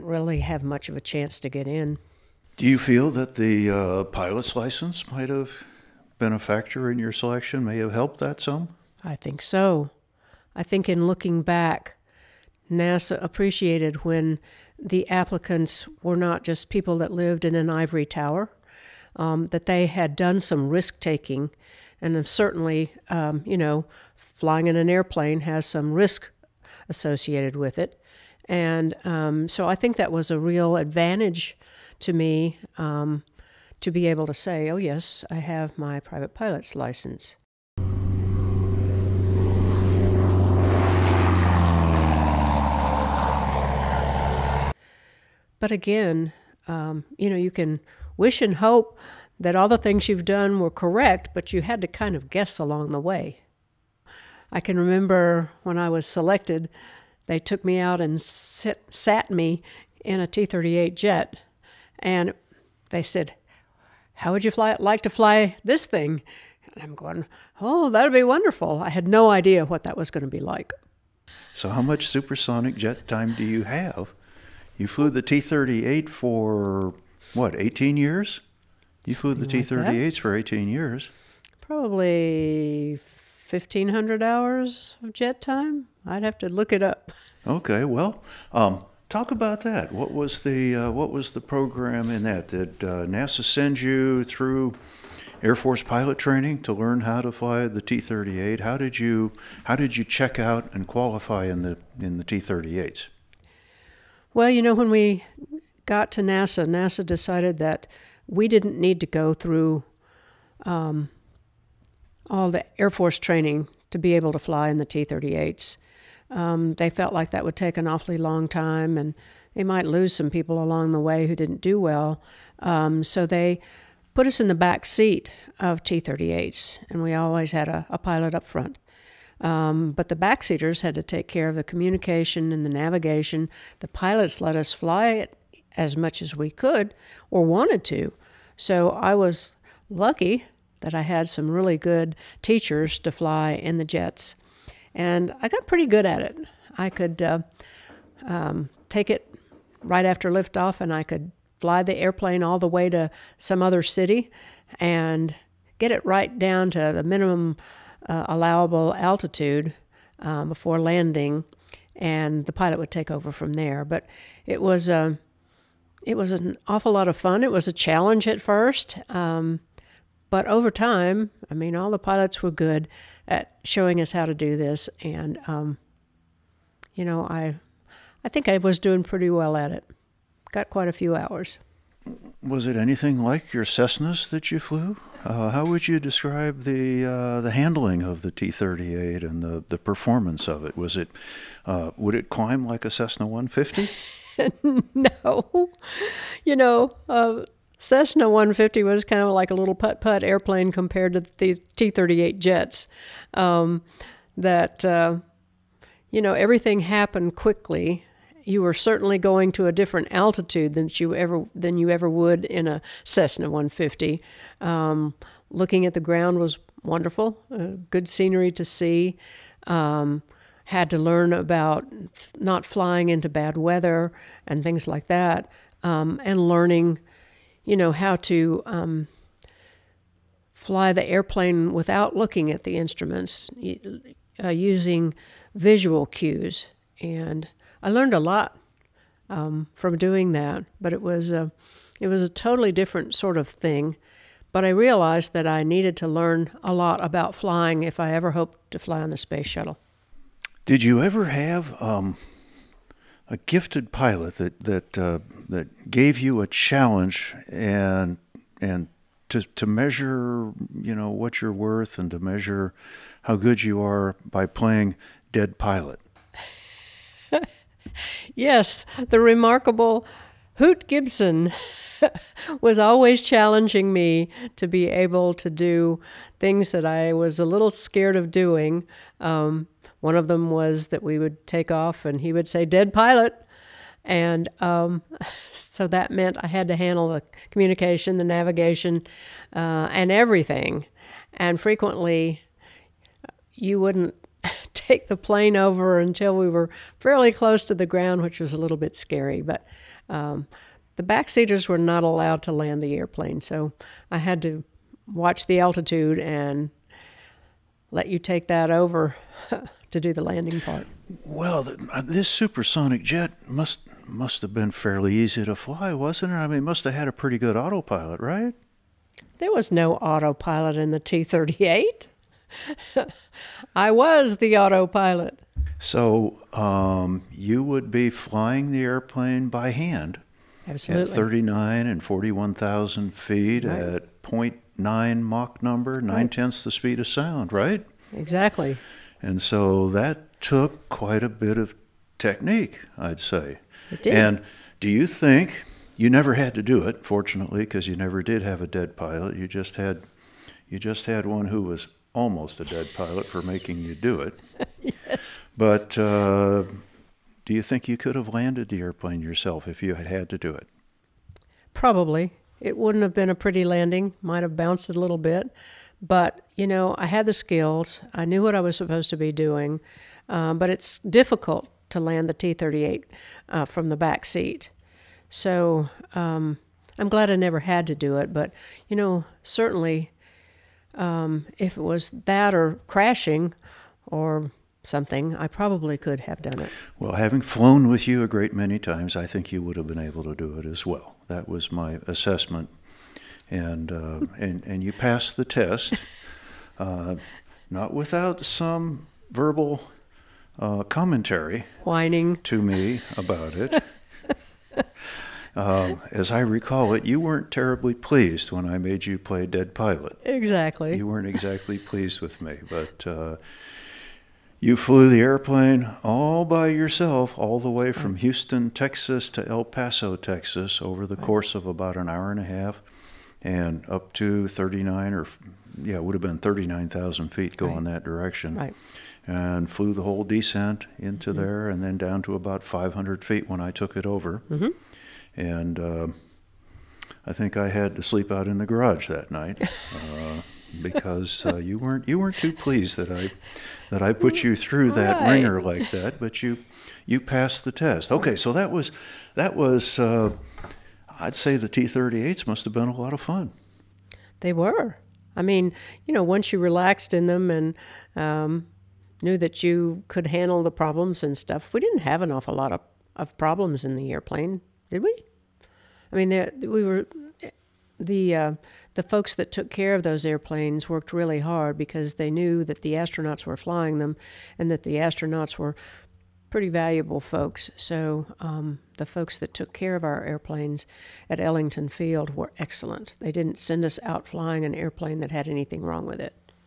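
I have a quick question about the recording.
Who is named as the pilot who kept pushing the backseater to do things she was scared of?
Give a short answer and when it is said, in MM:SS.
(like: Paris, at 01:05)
Hoot Gibson, at 04:30.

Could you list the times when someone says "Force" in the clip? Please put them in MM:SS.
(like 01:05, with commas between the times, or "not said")
01:35, 01:52.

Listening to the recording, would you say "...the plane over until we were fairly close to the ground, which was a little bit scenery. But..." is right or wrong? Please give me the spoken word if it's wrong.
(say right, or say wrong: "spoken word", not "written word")
wrong: "scary", not "scenery".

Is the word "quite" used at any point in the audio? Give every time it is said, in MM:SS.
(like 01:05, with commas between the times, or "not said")
03:00, 05:40.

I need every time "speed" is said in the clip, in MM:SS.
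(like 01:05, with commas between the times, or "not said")
05:36.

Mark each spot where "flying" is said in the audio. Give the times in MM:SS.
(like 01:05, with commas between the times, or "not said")
00:24, 03:42, 04:07, 05:28, 07:53, 08:04.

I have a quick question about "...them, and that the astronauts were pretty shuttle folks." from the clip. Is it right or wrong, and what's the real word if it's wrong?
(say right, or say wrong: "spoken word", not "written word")
wrong: "valuable", not "shuttle".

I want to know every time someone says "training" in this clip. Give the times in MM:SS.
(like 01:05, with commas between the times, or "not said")
01:36, 01:53.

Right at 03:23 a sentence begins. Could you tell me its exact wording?
Um, that, uh, you know, everything happened quickly.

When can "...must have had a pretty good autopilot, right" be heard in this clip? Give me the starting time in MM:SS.
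05:16.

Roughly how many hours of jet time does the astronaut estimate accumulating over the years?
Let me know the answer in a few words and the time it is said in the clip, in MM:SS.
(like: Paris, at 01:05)
1500 hours, at 01:23.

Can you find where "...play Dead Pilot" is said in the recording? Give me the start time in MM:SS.
06:49.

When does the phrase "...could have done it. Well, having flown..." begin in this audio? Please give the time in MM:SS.
06:25.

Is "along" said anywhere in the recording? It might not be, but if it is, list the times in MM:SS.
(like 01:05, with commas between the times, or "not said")
00:52, 02:00.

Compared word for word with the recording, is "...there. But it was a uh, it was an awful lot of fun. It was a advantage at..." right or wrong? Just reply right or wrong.
wrong.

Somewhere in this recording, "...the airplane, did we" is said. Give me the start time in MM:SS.
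07:43.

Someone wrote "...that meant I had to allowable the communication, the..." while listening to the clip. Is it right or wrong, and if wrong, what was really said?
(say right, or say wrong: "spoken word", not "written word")
wrong: "handle", not "allowable".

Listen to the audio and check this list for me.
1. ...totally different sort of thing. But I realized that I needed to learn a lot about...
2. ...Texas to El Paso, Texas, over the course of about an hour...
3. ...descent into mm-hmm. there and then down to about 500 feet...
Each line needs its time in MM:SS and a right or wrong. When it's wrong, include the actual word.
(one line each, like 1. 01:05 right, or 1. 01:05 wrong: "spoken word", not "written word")
1. 04:02 right
2. 06:58 right
3. 07:10 right.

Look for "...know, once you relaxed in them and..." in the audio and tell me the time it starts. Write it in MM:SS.
07:36.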